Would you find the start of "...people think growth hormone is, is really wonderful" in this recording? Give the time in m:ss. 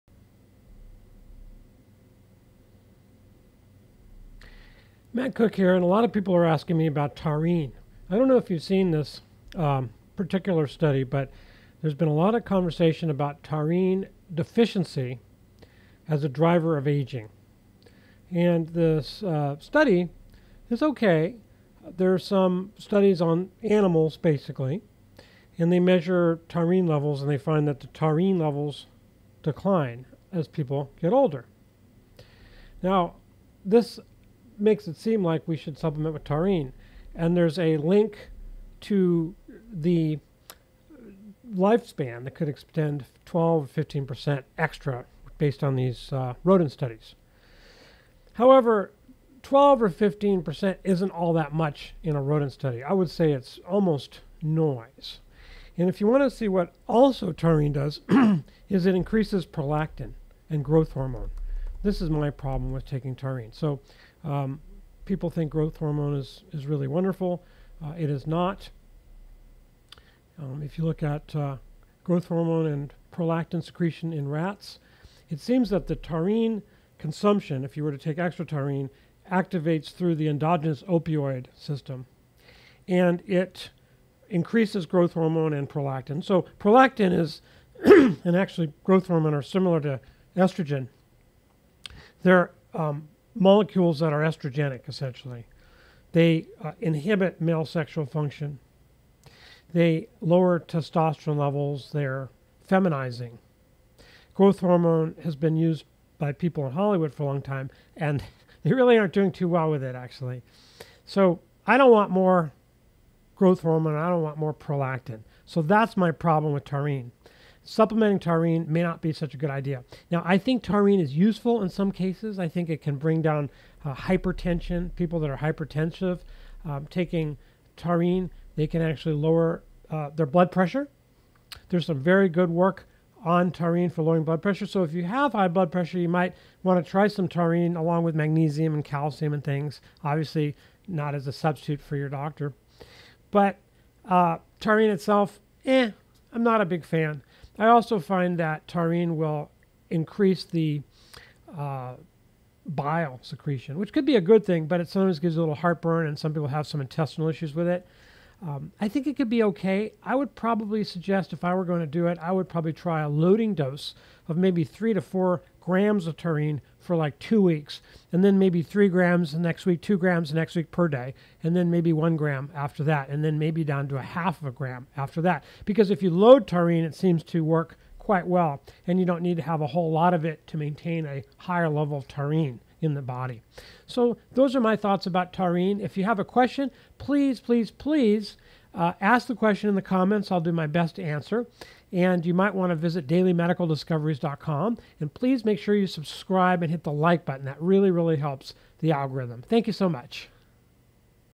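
1:05.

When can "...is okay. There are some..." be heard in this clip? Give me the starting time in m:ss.
0:20.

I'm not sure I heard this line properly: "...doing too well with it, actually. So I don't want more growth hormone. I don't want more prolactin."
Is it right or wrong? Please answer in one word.
right.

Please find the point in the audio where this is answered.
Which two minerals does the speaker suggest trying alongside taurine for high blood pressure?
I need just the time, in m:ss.
2:18.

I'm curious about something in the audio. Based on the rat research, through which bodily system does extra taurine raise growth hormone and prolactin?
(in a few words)
endogenous opioid system.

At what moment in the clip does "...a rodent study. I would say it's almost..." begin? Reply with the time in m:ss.
0:52.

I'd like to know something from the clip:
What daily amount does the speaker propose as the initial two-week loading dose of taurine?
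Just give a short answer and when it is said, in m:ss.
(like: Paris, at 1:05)
3 to 4 grams, at 2:44.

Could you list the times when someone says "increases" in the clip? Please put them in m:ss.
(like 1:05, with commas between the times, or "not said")
0:58, 1:24, 2:29.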